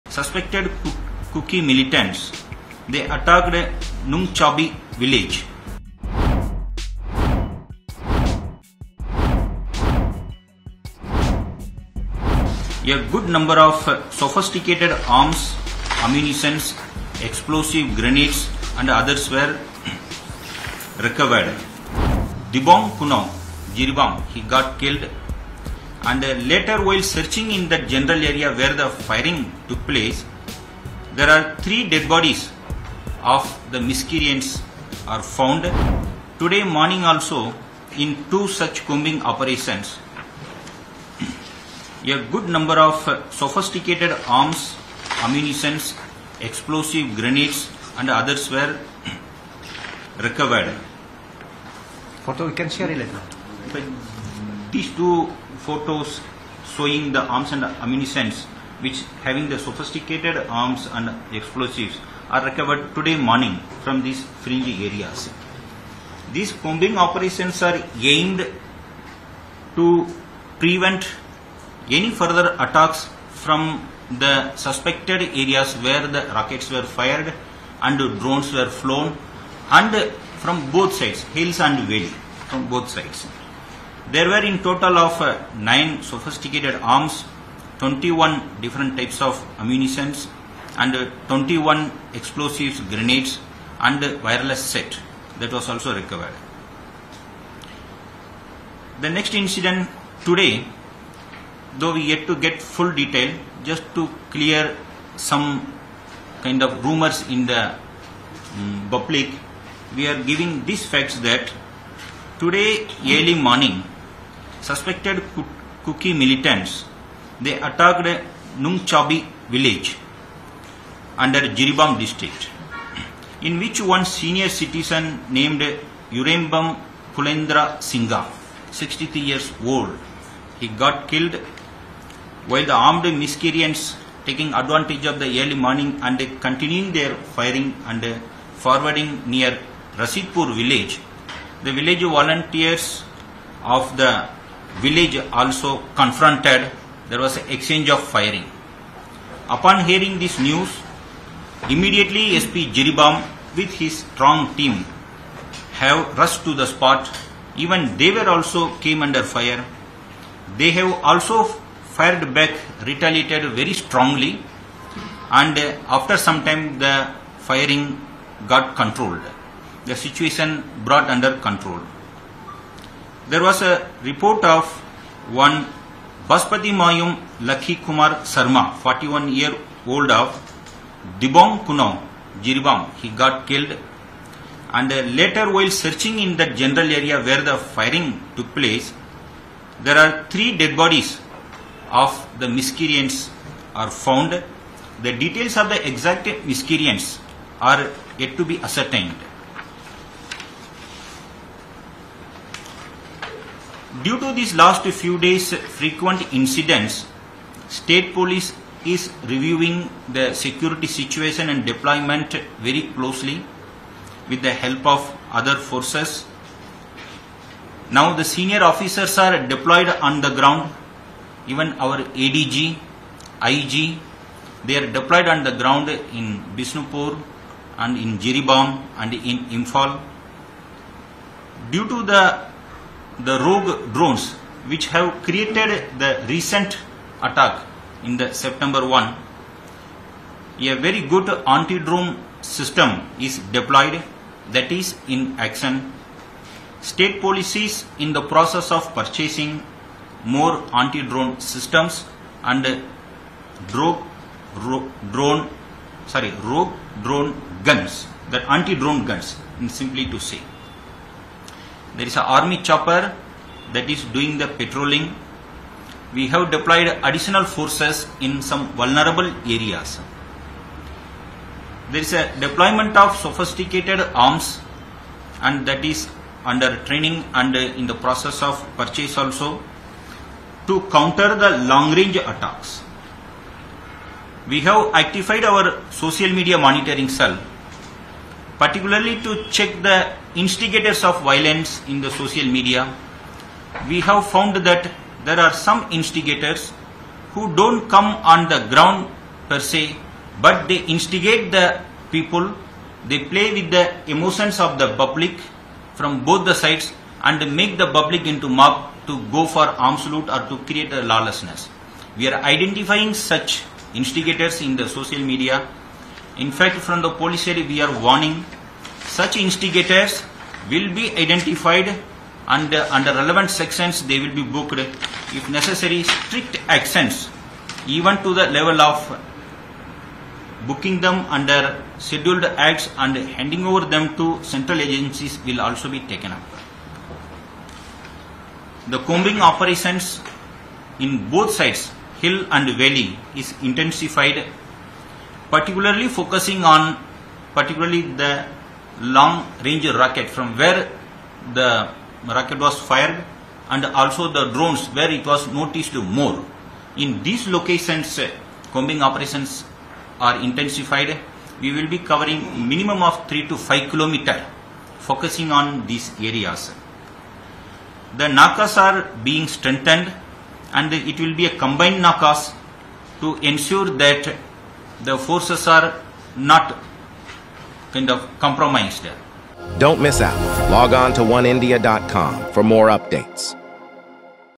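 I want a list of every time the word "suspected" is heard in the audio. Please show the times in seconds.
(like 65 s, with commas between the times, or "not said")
0 s, 74 s, 114 s.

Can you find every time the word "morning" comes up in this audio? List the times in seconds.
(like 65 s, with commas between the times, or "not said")
36 s, 63 s, 113 s, 135 s.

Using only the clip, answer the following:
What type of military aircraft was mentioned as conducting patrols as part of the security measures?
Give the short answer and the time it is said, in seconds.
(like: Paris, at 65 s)
Army chopper, at 262 s.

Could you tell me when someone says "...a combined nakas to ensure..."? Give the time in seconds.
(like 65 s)
371 s.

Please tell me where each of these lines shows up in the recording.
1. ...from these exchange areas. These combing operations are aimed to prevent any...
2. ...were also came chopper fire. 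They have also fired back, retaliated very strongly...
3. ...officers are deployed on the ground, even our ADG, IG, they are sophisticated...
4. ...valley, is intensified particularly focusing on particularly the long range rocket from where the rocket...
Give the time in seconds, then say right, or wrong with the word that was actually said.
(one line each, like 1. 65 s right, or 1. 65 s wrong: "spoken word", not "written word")
1. 63 s wrong: "fringe", not "exchange"
2. 158 s wrong: "under", not "chopper"
3. 218 s wrong: "deployed", not "sophisticated"
4. 342 s right.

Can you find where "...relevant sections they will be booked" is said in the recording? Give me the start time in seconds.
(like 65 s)
323 s.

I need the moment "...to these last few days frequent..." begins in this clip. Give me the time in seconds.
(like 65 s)
204 s.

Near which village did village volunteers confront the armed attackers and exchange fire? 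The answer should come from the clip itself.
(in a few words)
Rasipur.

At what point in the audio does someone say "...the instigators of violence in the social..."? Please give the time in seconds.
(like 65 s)
289 s.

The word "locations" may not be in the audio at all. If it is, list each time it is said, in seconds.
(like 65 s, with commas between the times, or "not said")
357 s.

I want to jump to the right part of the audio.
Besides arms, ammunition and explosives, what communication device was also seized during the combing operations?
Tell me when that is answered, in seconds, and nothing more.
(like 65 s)
94 s.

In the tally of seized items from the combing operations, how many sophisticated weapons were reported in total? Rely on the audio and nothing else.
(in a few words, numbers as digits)
9.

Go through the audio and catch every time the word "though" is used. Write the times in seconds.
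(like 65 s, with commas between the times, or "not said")
101 s.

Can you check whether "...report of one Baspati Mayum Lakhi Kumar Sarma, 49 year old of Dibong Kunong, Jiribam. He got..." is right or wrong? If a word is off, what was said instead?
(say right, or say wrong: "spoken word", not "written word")
wrong: "41", not "49".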